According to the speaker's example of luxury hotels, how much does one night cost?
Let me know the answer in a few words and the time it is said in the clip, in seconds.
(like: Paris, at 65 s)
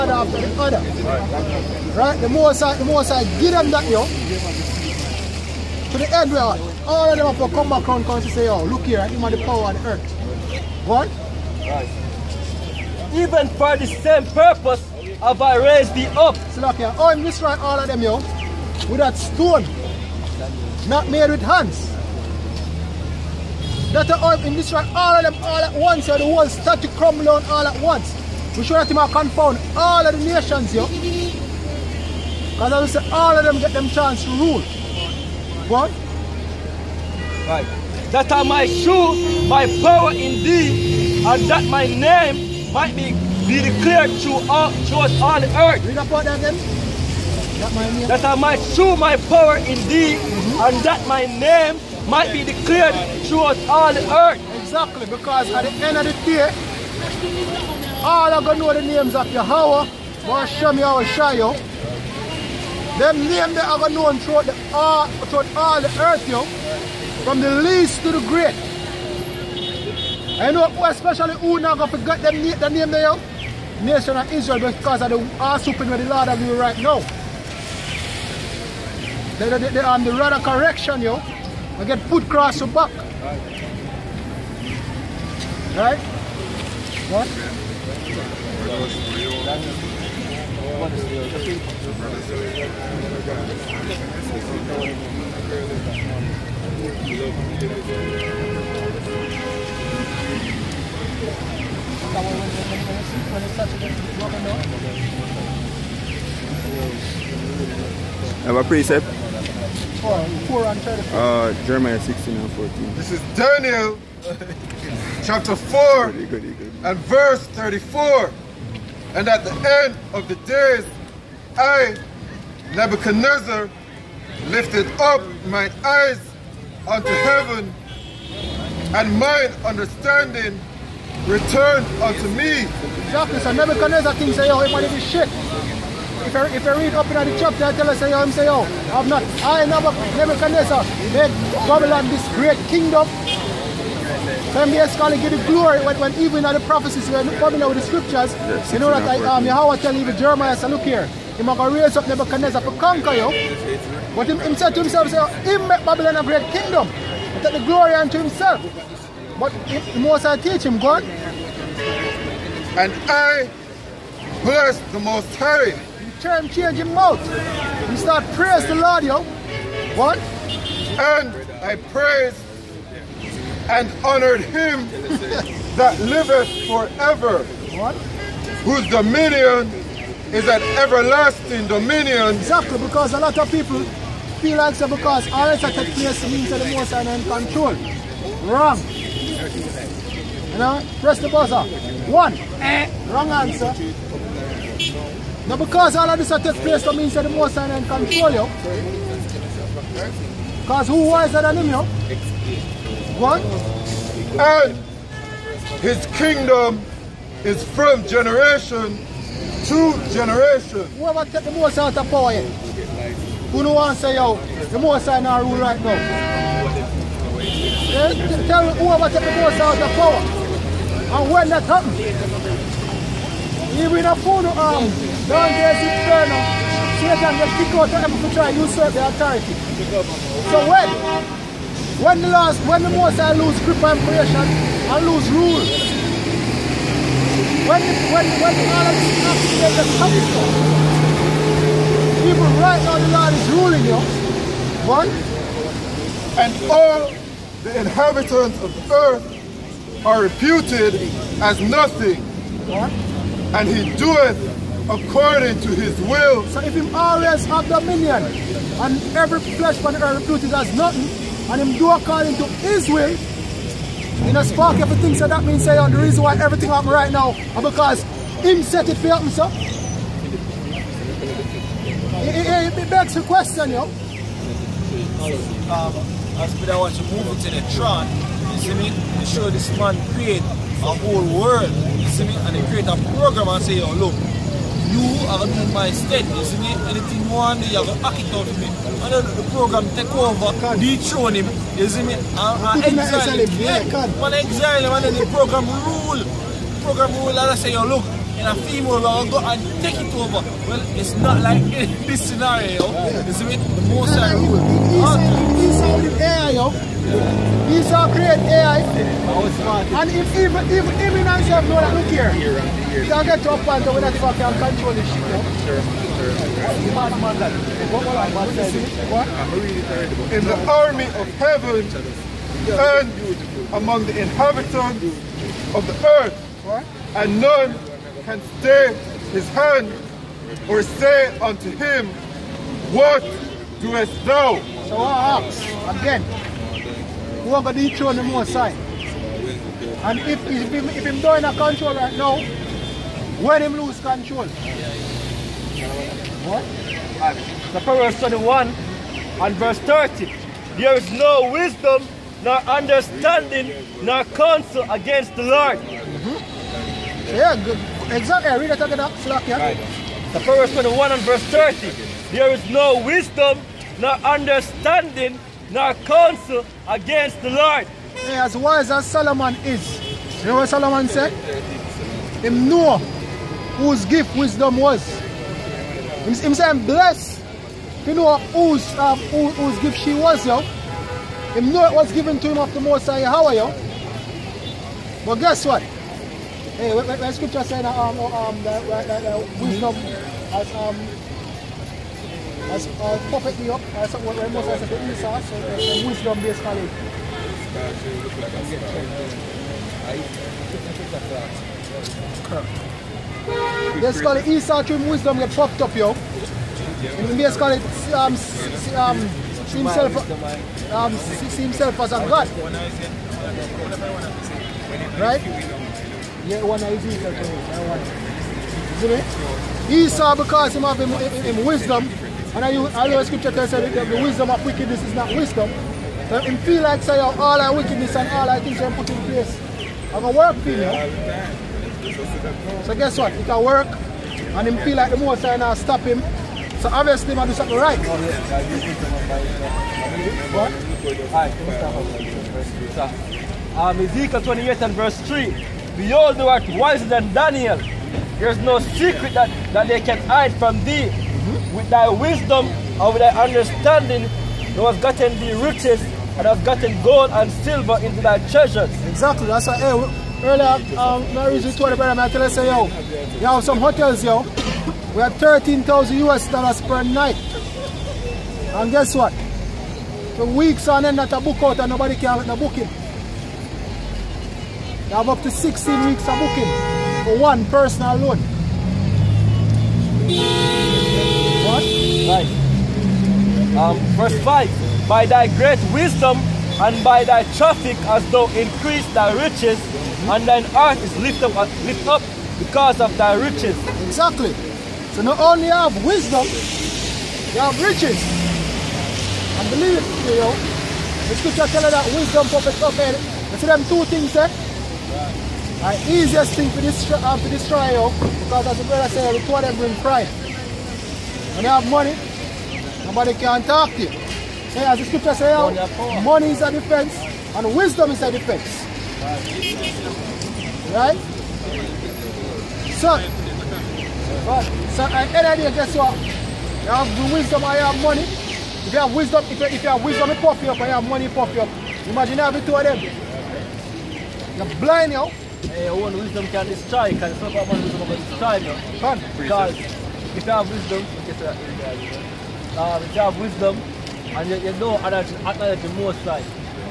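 $13,000, at 465 s.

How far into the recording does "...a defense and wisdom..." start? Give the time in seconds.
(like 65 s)
516 s.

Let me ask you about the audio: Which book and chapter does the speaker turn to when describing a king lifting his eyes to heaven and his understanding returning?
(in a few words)
Daniel chapter 4.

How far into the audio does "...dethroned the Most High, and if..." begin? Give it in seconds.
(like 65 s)
337 s.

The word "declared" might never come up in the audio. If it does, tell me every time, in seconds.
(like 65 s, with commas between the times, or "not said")
43 s, 52 s.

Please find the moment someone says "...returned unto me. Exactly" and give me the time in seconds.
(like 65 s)
131 s.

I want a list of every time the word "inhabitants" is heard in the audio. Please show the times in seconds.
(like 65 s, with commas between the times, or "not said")
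247 s, 324 s.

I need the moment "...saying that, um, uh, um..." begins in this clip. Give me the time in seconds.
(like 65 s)
387 s.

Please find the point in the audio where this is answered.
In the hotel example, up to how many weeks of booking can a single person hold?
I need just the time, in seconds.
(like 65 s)
475 s.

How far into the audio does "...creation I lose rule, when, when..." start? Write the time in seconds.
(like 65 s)
233 s.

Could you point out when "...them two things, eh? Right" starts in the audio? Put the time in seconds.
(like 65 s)
503 s.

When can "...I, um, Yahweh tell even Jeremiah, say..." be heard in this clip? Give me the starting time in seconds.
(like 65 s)
149 s.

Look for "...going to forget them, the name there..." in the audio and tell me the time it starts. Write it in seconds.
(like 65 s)
71 s.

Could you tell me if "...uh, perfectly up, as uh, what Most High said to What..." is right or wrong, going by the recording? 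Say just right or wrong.
wrong.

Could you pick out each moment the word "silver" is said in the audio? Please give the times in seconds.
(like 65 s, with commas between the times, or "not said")
457 s.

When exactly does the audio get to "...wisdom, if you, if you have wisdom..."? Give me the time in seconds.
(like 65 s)
529 s.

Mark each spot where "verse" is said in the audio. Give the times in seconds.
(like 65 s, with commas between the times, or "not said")
117 s, 349 s, 361 s, 444 s, 484 s.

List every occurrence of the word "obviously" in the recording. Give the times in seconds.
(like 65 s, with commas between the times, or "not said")
436 s.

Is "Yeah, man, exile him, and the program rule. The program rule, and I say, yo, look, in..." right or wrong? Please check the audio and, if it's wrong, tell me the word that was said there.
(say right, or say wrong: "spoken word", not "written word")
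right.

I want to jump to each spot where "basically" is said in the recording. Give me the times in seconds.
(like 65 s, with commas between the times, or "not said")
144 s, 396 s.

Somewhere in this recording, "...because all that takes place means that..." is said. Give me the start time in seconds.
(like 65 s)
184 s.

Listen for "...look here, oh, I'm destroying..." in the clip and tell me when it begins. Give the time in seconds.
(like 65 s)
16 s.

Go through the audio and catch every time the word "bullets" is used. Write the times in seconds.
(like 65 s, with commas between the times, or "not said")
not said.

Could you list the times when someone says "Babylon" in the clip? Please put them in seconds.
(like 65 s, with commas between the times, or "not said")
141 s, 155 s.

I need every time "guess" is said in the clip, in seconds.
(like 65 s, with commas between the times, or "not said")
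385 s, 432 s, 468 s, 525 s.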